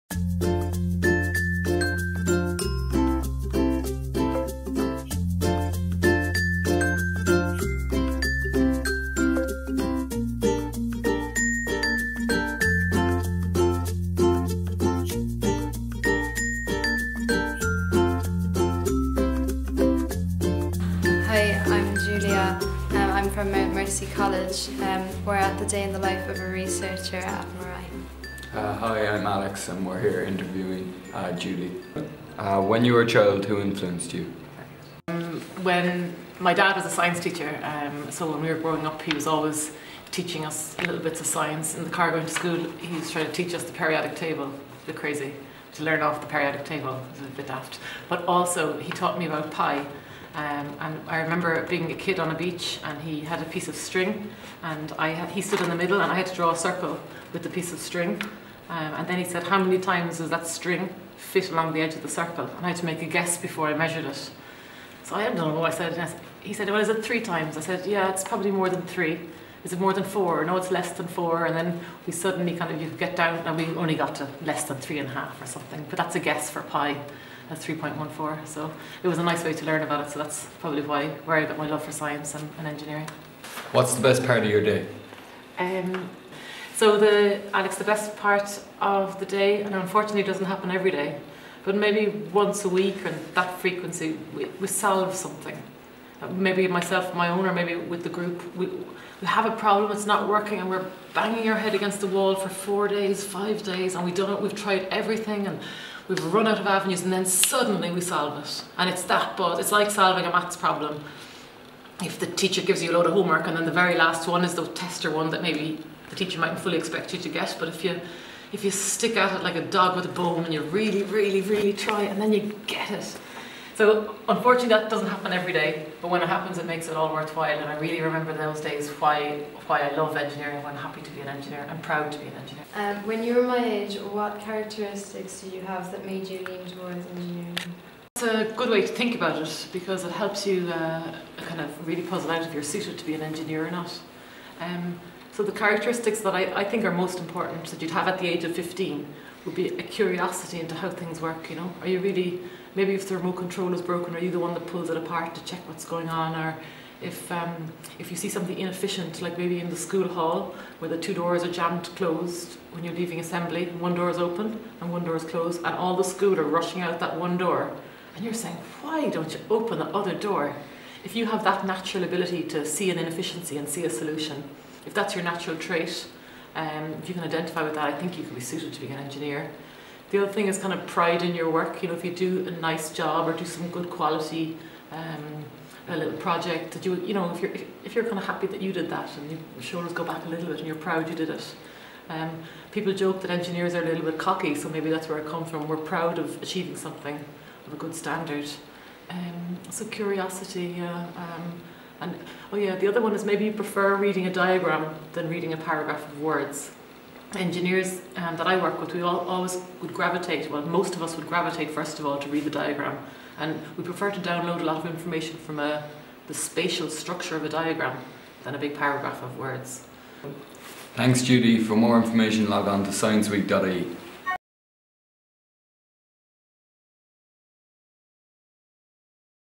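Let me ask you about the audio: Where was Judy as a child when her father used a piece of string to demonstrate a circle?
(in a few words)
A beach.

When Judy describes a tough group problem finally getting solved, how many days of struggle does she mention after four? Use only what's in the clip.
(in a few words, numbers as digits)
5.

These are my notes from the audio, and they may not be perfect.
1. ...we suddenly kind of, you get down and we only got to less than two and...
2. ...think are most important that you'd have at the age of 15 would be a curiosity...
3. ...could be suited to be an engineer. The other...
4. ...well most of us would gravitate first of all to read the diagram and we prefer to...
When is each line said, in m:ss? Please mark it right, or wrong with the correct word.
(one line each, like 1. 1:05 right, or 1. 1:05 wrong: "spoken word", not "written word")
1. 1:12 wrong: "three", not "two"
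2. 2:26 right
3. 2:58 right
4. 3:30 right.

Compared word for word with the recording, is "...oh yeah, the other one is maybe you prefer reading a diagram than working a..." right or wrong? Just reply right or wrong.
wrong.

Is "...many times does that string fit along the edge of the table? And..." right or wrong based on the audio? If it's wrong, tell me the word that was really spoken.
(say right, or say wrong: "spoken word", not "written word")
wrong: "circle", not "table".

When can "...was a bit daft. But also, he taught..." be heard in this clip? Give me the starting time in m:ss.
0:47.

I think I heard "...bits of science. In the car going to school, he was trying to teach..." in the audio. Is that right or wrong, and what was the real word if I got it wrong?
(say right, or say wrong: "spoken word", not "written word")
right.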